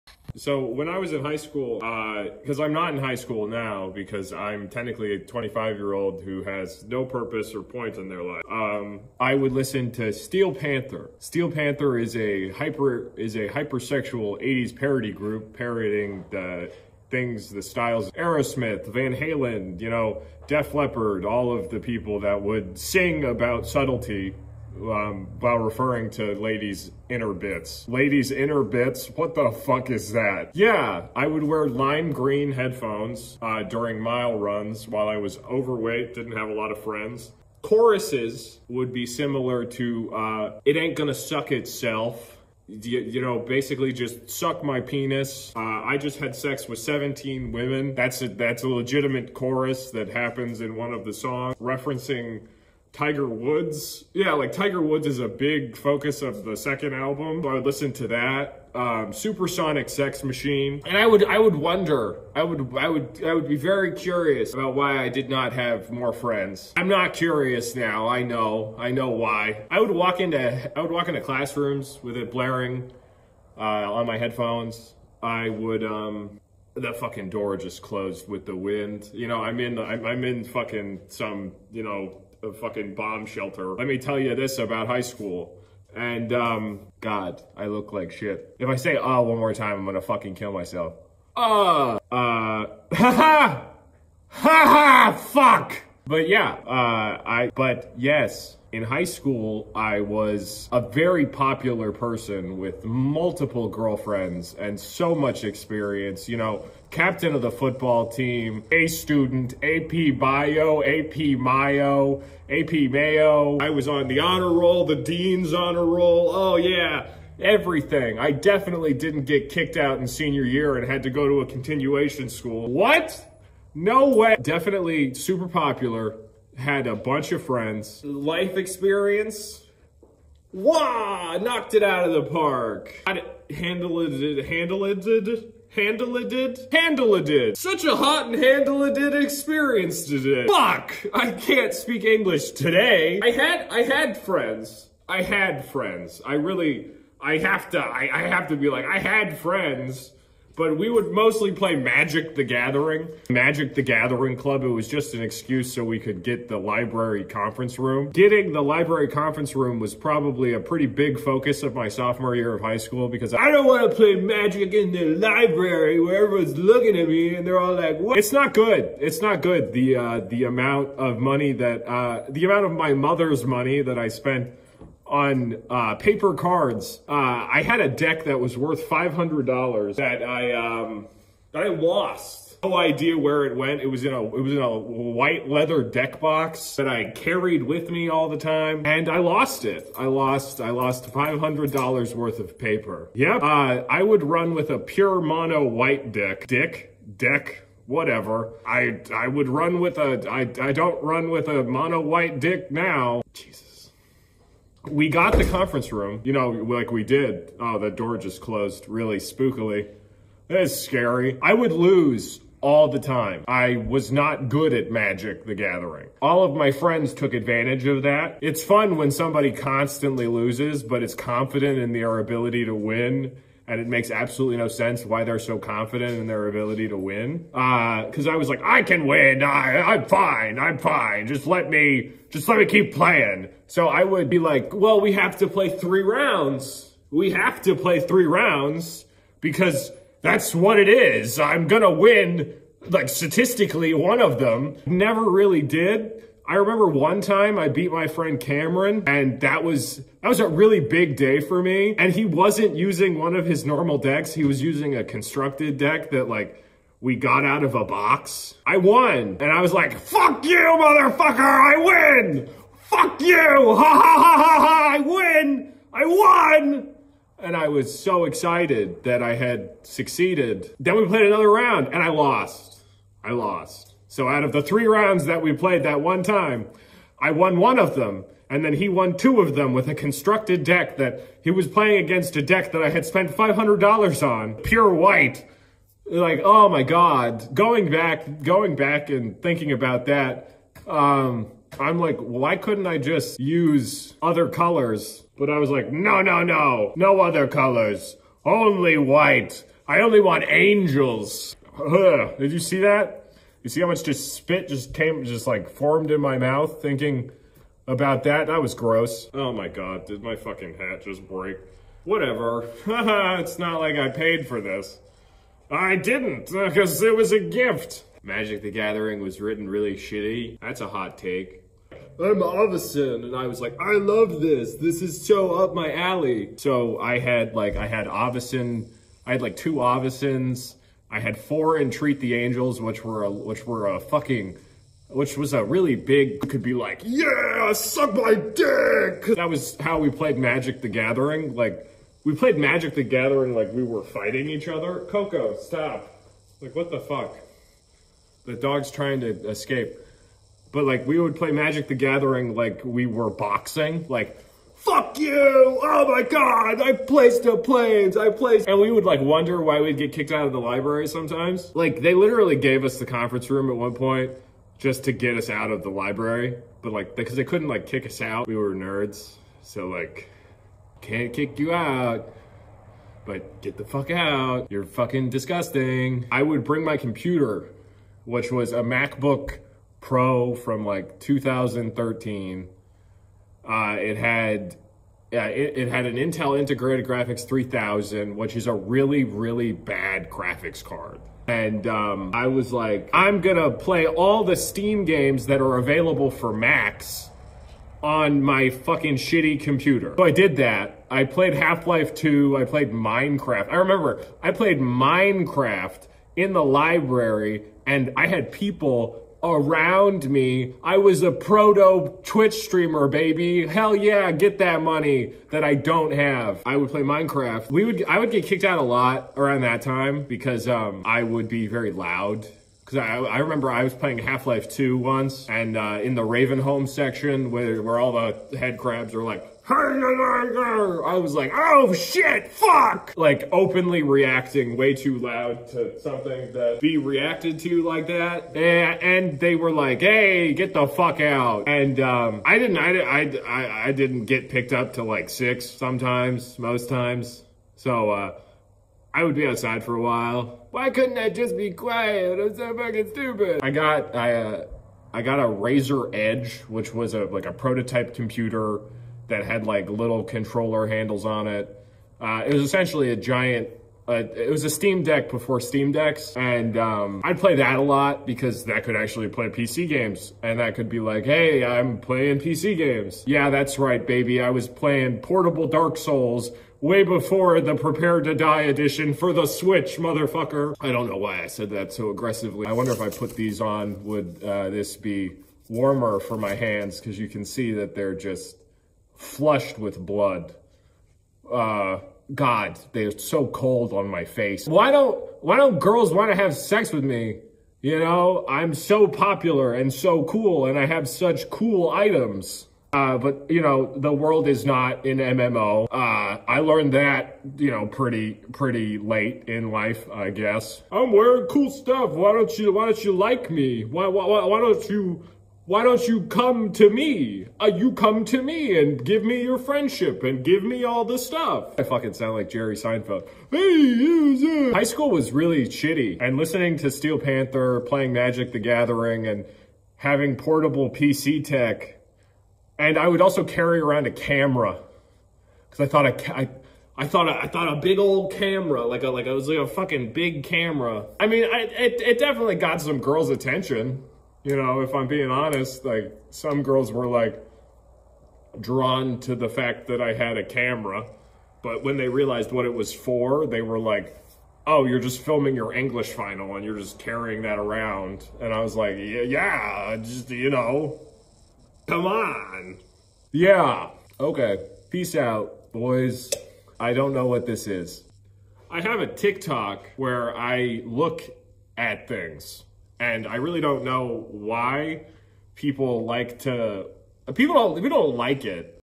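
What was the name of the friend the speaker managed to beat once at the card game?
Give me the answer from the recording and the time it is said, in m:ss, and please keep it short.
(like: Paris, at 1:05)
Cameron, at 4:08.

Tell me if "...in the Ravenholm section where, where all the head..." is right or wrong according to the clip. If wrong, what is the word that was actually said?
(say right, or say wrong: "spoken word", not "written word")
right.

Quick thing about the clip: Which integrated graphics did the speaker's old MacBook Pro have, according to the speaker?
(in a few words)
Intel Integrated Graphics 3000.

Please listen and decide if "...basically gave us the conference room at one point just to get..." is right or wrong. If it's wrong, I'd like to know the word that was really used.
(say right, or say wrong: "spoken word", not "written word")
wrong: "literally", not "basically".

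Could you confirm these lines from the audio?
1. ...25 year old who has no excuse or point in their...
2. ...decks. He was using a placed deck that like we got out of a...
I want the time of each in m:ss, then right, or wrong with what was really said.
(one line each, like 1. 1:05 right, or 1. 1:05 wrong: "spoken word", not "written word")
1. 0:05 wrong: "purpose", not "excuse"
2. 4:13 wrong: "constructed", not "placed".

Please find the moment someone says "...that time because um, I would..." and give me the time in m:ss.
6:59.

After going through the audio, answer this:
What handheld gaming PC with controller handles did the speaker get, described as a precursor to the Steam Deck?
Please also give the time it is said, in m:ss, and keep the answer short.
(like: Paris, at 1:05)
Razer Edge, at 7:35.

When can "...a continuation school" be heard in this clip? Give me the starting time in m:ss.
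2:01.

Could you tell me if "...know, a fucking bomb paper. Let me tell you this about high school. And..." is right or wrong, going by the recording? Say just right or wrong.
wrong.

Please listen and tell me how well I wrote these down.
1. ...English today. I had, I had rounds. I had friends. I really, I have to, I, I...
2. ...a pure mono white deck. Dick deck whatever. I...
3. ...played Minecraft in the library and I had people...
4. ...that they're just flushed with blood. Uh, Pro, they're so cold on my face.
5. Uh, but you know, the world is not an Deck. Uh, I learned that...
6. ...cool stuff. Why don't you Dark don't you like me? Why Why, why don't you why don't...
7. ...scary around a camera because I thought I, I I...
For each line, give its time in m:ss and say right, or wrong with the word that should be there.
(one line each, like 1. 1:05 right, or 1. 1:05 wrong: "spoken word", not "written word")
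1. 2:22 wrong: "friends", not "rounds"
2. 3:14 right
3. 6:44 right
4. 8:07 wrong: "God", not "Pro"
5. 8:22 wrong: "MMO", not "Deck"
6. 8:31 wrong: "Why", not "Dark"
7. 8:53 wrong: "carry", not "scary".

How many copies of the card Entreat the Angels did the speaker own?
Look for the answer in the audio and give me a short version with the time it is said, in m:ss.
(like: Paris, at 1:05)
4, at 5:31.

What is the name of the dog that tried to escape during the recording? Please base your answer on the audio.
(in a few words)
Coco.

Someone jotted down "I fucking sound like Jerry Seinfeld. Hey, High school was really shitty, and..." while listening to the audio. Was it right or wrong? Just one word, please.
right.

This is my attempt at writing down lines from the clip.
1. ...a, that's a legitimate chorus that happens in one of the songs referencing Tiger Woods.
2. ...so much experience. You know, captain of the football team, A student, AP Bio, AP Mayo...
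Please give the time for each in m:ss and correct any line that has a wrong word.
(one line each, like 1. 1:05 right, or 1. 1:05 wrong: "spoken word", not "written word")
1. 0:48 right
2. 1:44 right.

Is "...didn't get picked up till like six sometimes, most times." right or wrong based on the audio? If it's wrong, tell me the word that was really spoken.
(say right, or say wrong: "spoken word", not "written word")
right.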